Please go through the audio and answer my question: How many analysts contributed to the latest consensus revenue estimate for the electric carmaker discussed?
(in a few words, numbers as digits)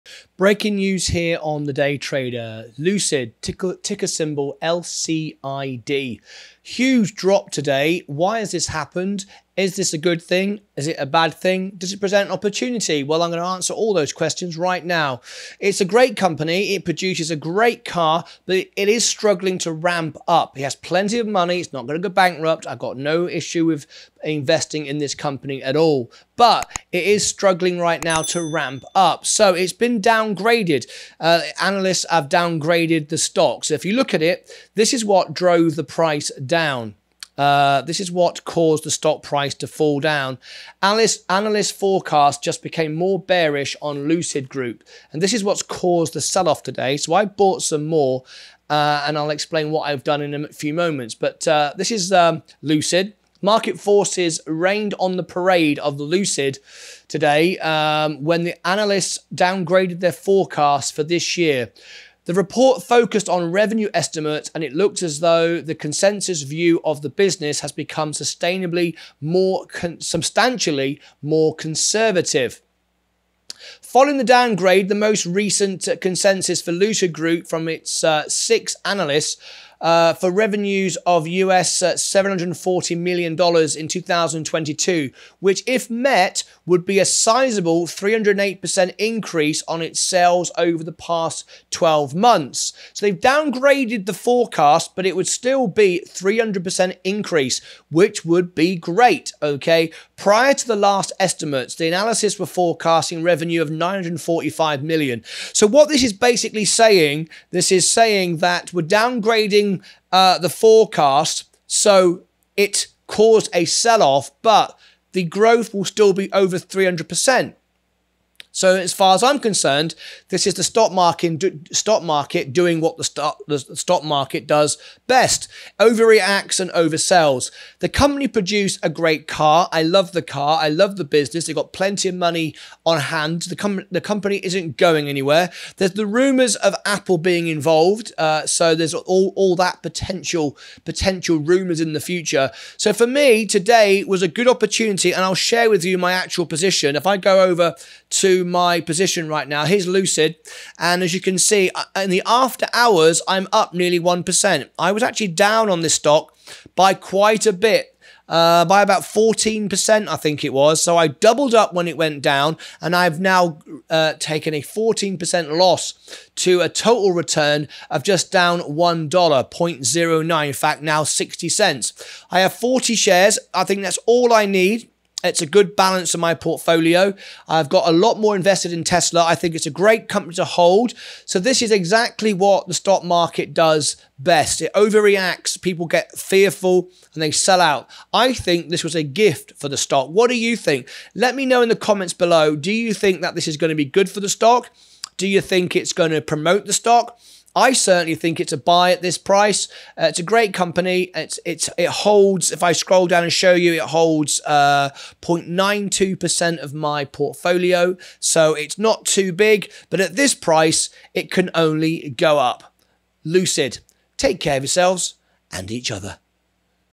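6.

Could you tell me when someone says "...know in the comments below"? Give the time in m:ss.
3:11.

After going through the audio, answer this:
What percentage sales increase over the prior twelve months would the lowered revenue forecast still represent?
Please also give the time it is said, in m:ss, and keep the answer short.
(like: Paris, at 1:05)
308%, at 1:27.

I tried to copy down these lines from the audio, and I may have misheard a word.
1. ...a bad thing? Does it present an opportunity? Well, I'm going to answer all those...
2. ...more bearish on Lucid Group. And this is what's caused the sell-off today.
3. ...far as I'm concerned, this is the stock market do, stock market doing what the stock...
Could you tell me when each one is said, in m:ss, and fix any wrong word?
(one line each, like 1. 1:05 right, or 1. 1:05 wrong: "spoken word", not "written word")
1. 0:10 right
2. 0:42 right
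3. 1:58 right.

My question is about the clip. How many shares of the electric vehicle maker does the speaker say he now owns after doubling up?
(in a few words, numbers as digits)
40.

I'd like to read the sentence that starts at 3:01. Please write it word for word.
So this is exactly what the stock market does best.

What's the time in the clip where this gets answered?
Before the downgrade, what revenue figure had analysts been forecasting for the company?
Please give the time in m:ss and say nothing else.
1:43.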